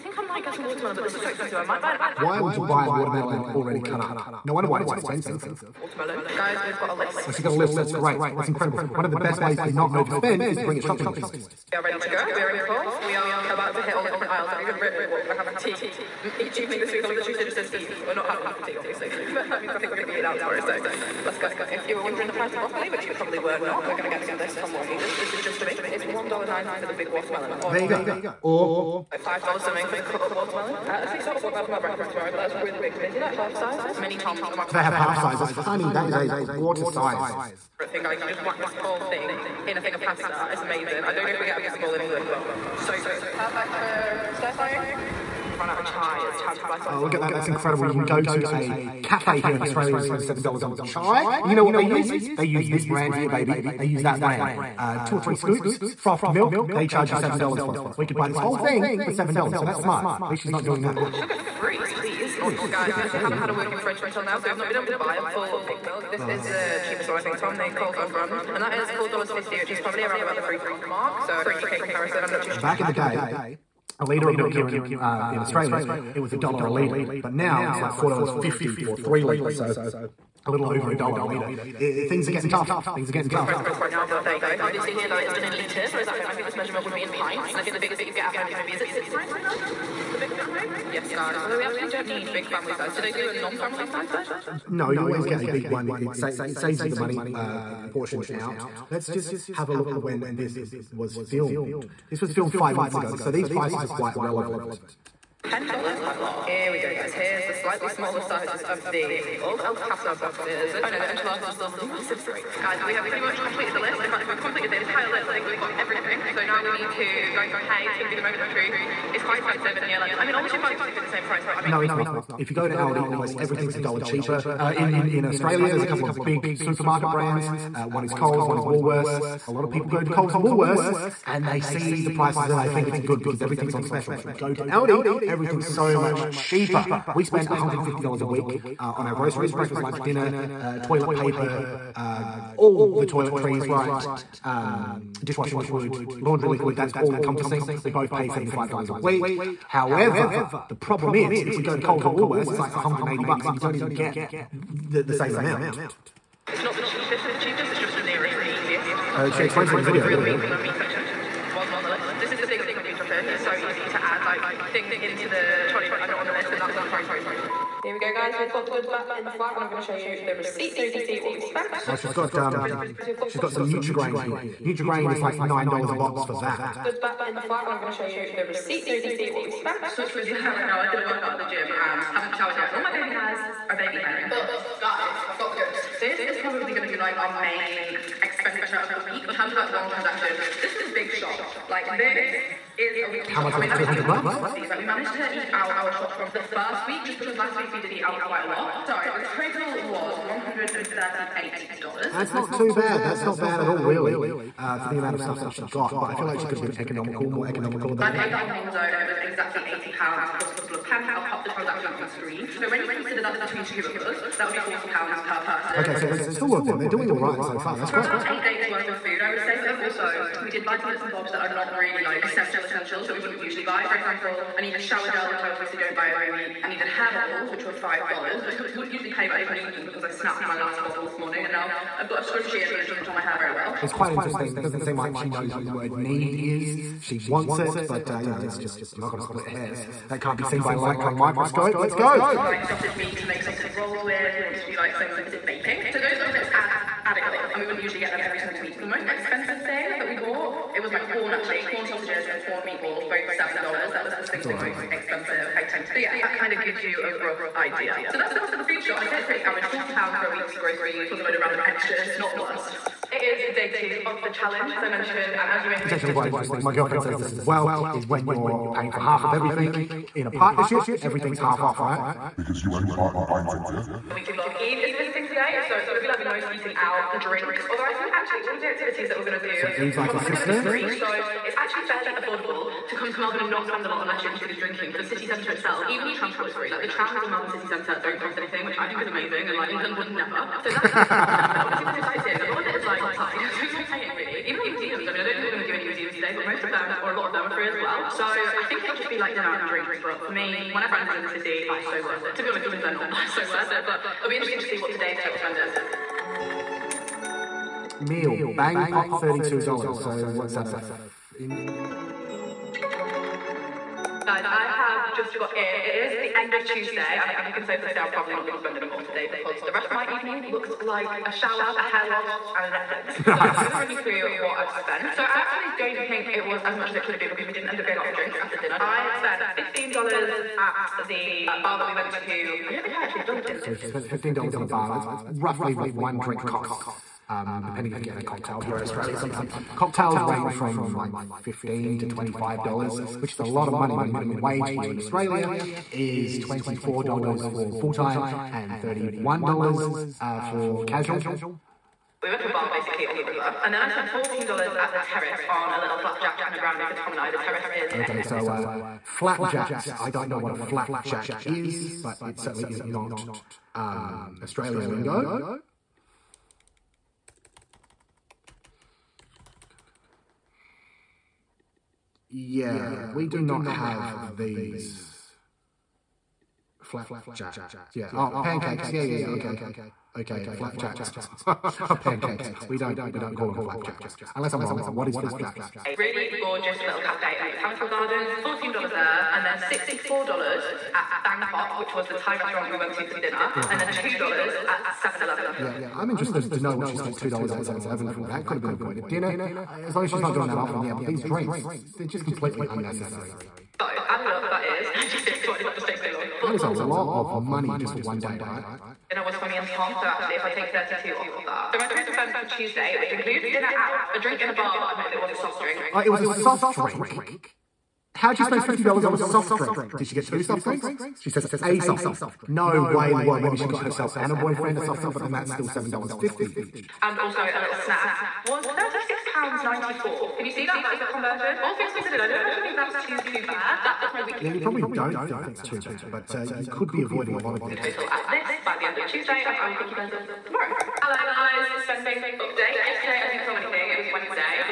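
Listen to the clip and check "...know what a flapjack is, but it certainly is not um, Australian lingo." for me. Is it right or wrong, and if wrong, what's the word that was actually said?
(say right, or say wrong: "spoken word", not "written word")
right.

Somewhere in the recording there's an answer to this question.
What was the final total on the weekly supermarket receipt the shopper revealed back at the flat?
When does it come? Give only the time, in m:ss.
3:20.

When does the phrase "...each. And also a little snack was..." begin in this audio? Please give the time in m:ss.
7:06.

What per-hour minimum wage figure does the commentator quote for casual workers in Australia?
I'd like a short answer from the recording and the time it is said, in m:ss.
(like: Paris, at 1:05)
$31, at 5:48.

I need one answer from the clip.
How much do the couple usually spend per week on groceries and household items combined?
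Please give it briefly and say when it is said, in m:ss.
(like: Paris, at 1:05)
$150, at 2:17.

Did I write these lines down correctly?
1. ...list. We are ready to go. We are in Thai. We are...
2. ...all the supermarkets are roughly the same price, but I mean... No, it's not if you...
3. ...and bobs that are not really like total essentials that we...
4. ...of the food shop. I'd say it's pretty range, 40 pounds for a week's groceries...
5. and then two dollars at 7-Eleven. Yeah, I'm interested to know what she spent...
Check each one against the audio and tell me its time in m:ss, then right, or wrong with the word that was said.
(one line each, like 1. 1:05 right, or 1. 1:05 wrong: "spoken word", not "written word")
1. 0:11 wrong: "Coles", not "Thai"
2. 2:00 right
3. 3:41 wrong: "essential", not "total"
4. 4:18 wrong: "average", not "range"
5. 6:33 right.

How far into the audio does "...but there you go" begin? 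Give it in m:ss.
1:24.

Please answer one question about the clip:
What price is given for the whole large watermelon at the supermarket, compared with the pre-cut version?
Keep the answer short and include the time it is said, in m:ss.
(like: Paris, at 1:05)
$1.90, at 0:26.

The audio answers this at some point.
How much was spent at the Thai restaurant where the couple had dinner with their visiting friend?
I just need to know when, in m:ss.
6:29.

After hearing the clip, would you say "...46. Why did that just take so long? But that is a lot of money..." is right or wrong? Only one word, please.
wrong.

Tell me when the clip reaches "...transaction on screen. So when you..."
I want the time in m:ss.
3:31.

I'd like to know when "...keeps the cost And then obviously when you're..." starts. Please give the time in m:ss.
4:50.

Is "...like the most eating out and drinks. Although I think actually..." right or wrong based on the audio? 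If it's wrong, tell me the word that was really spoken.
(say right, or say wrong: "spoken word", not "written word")
right.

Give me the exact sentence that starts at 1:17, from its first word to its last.
But now it's like $4.50 for three litres.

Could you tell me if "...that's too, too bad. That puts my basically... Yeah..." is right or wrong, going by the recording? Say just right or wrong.
wrong.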